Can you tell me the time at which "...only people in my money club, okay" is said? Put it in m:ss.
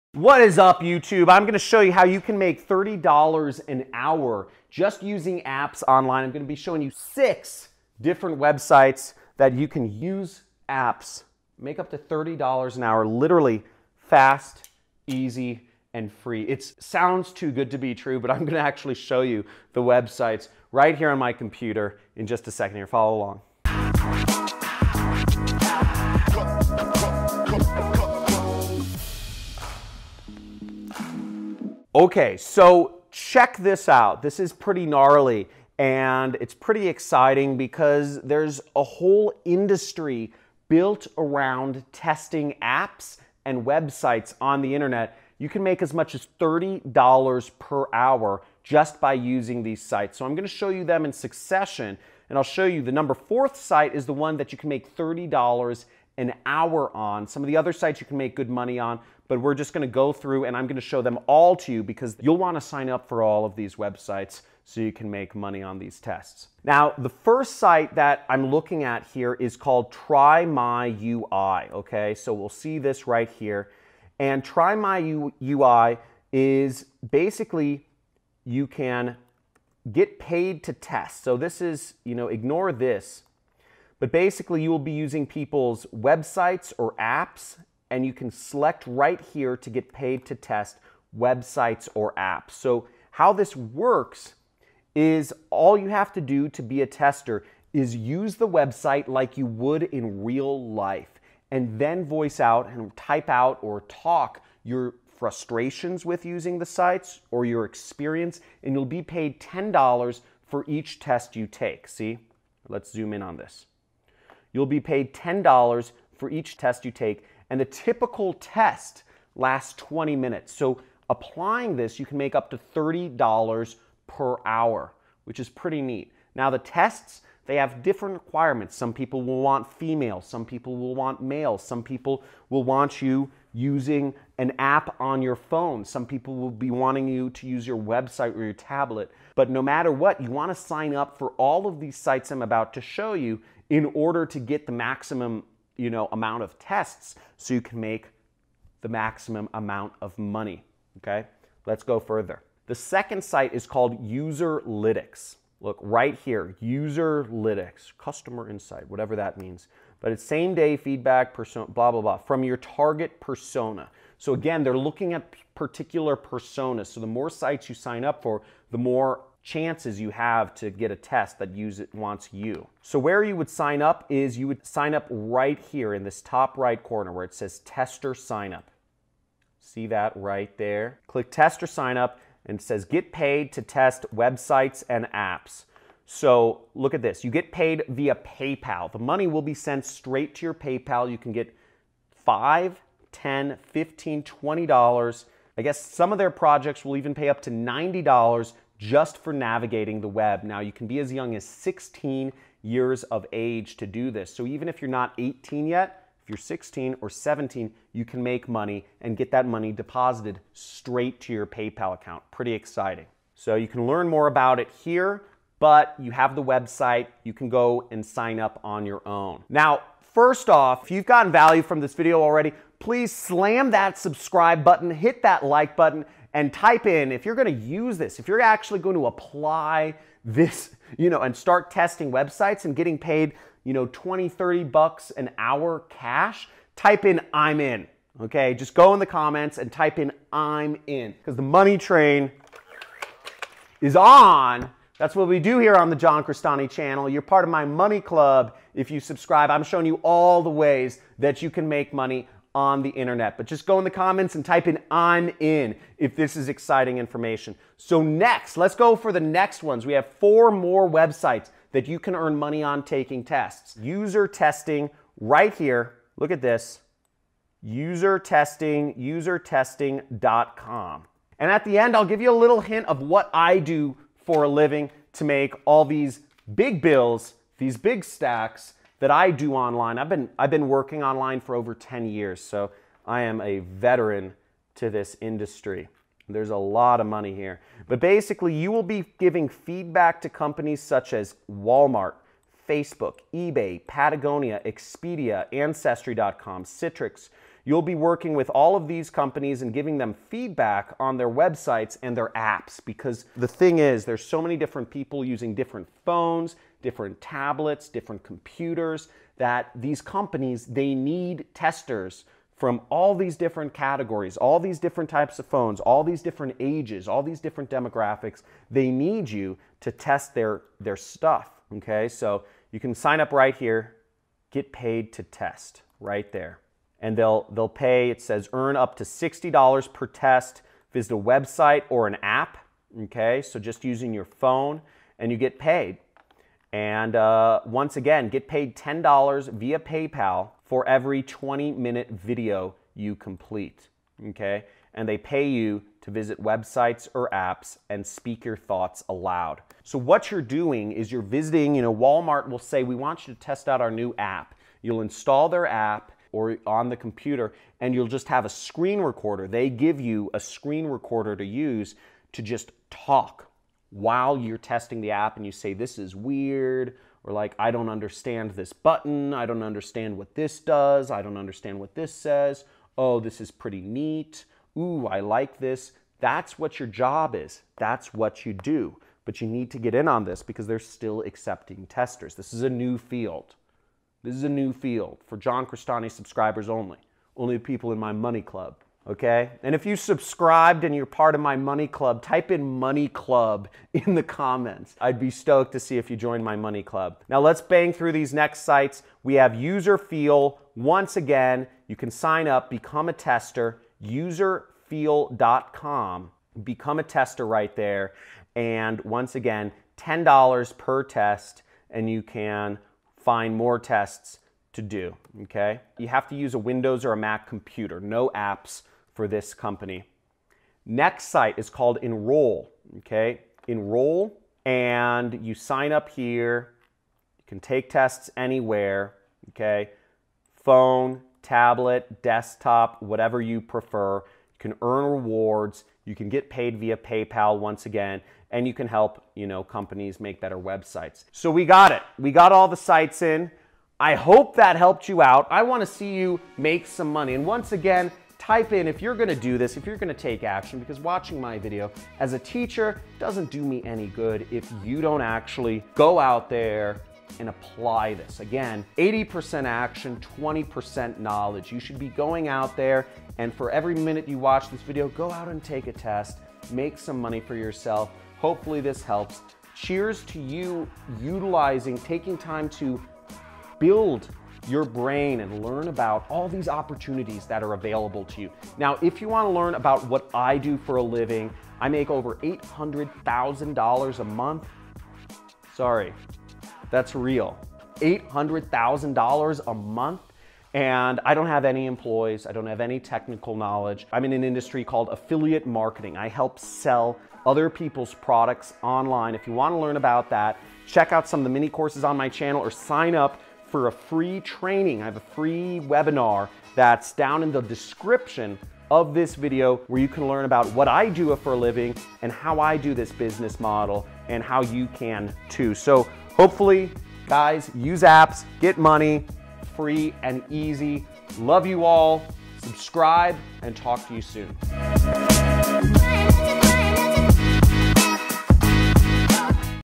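6:27.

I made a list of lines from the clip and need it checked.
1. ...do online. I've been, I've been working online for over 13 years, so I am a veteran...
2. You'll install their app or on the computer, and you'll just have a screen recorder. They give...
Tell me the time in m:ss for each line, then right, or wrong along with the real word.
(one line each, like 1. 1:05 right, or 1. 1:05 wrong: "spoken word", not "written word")
1. 4:39 wrong: "10", not "13"
2. 5:54 right.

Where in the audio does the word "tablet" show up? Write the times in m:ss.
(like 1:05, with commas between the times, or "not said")
2:18, 5:07, 7:11.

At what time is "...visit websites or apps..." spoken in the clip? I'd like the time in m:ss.
5:46.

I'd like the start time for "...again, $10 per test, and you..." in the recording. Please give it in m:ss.
6:49.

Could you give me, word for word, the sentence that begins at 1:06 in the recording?
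Now, the first site that I'm looking at here is called Try My UI, okay?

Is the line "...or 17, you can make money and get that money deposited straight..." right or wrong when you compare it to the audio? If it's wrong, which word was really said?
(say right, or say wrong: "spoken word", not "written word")
right.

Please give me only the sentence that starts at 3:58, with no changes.
Okay, just go in the comments and type in I'm in because the money train is on.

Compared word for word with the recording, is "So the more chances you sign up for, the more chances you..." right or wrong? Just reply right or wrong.
wrong.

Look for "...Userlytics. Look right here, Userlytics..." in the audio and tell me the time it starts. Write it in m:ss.
2:34.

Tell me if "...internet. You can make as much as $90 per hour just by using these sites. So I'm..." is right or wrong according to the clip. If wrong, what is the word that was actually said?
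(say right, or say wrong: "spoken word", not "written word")
wrong: "30", not "90".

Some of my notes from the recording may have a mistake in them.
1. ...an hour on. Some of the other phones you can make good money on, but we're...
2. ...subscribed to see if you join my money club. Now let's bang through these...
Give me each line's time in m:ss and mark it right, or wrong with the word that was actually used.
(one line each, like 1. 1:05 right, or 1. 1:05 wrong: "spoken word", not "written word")
1. 0:56 wrong: "sites", not "phones"
2. 6:35 wrong: "stoked", not "subscribed".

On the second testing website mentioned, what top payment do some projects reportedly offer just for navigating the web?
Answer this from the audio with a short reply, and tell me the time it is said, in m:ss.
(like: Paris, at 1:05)
$90, at 3:17.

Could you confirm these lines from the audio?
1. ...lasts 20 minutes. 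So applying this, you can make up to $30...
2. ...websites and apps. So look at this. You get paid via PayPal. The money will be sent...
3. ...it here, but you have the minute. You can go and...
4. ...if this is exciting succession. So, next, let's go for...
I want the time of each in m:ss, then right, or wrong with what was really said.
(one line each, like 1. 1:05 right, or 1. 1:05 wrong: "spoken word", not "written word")
1. 1:59 right
2. 3:04 right
3. 3:34 wrong: "website", not "minute"
4. 4:15 wrong: "information", not "succession".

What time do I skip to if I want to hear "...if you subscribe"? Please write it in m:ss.
4:08.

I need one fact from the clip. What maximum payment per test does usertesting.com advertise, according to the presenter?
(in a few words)
$60.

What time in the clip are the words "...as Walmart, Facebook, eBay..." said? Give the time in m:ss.
4:51.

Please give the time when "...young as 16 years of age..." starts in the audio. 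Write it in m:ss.
3:21.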